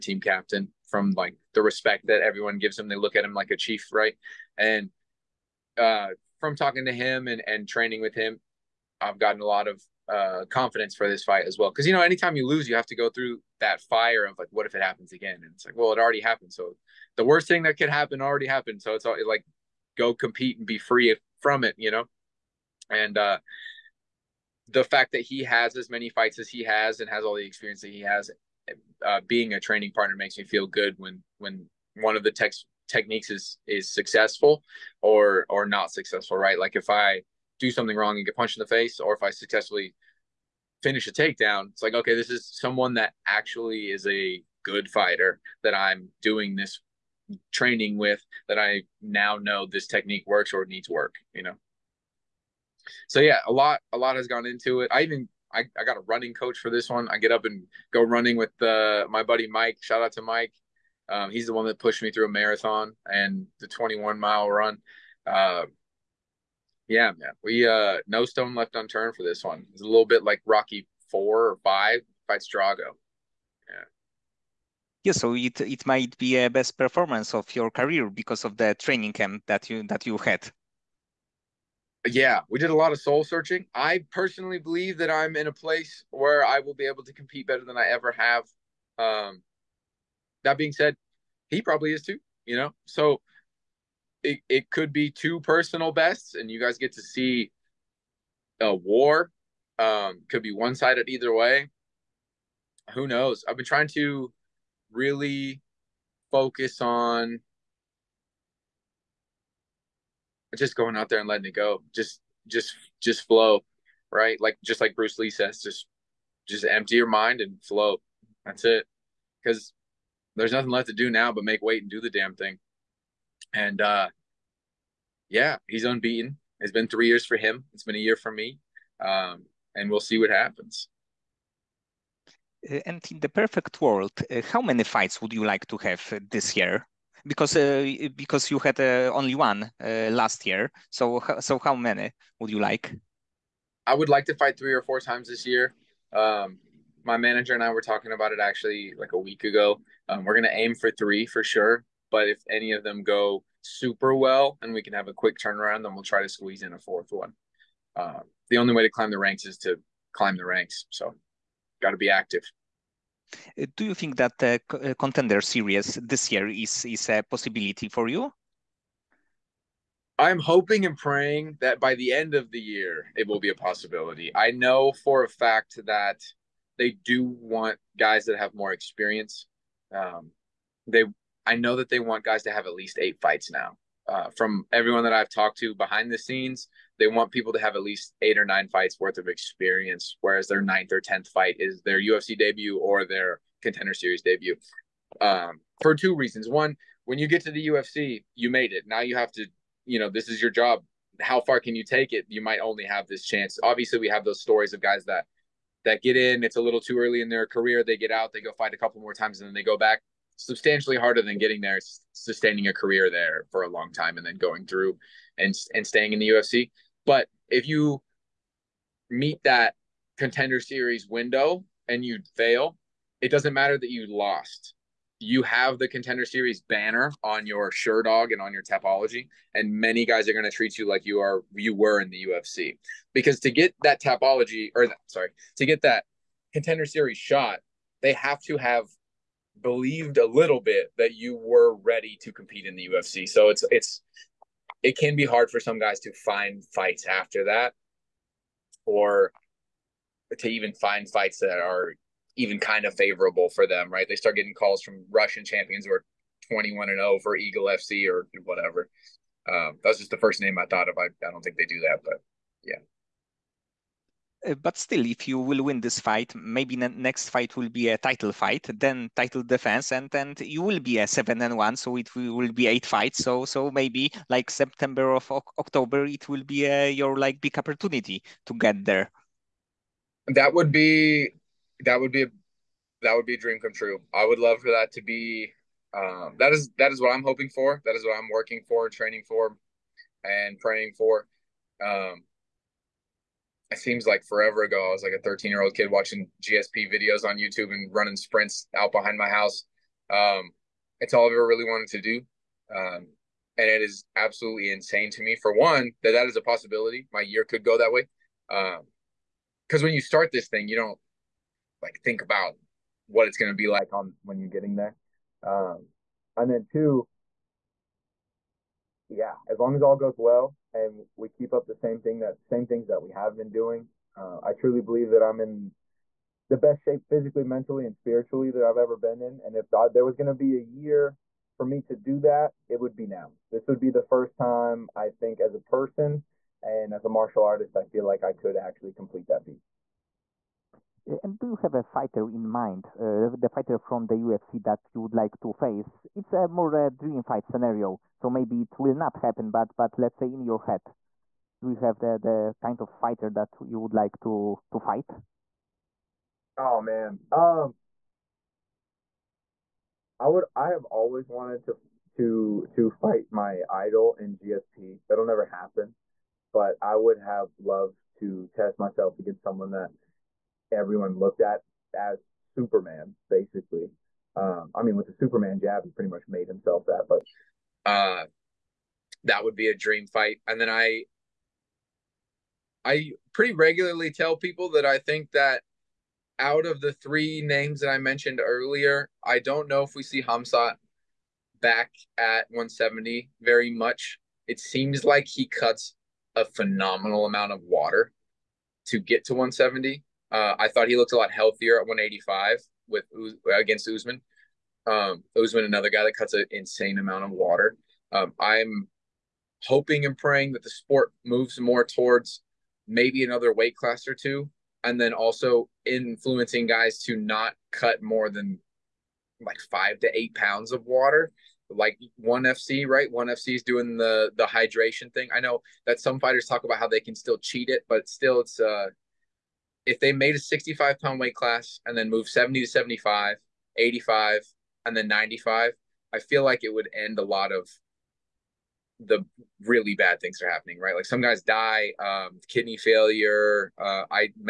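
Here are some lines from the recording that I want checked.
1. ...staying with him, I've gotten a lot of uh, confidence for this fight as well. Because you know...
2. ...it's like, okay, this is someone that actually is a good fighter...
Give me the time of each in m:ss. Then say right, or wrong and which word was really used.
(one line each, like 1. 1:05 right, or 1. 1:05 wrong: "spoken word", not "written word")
1. 0:07 wrong: "training", not "staying"
2. 0:41 right.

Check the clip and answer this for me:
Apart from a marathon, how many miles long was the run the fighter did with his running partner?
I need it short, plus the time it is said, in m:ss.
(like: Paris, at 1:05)
21, at 1:03.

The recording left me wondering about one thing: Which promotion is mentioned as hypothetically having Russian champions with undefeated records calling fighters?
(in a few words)
Eagle FC.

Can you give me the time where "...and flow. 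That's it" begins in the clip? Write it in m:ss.
1:57.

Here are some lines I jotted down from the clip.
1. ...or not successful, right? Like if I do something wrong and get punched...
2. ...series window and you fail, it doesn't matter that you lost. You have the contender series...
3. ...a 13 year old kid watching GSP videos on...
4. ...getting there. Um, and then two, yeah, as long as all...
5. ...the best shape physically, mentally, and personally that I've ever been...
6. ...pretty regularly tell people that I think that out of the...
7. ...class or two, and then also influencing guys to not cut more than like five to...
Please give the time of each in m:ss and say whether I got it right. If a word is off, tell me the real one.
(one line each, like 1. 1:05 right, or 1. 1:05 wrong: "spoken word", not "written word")
1. 0:35 right
2. 3:40 right
3. 4:55 right
4. 5:14 right
5. 5:26 wrong: "spiritually", not "personally"
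6. 6:23 right
7. 6:53 right.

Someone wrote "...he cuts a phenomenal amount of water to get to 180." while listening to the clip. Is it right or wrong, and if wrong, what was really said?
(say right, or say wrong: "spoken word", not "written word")
wrong: "170", not "180".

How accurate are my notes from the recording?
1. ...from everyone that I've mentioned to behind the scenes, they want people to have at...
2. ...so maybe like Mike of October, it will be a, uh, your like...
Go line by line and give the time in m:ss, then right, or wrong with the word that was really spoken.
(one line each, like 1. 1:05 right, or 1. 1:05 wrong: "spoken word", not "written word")
1. 3:04 wrong: "talked", not "mentioned"
2. 4:33 wrong: "September", not "Mike".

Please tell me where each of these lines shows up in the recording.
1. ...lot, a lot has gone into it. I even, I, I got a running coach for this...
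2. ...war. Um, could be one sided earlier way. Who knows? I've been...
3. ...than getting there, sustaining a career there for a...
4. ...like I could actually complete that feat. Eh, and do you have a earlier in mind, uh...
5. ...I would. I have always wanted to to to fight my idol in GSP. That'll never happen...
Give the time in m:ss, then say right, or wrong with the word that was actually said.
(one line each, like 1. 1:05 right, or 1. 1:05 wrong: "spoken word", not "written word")
1. 0:53 right
2. 1:38 wrong: "either", not "earlier"
3. 3:31 right
4. 5:38 wrong: "fighter", not "earlier"
5. 6:00 right.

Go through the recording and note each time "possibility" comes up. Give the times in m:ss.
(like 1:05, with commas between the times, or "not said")
2:47, 2:53, 5:06.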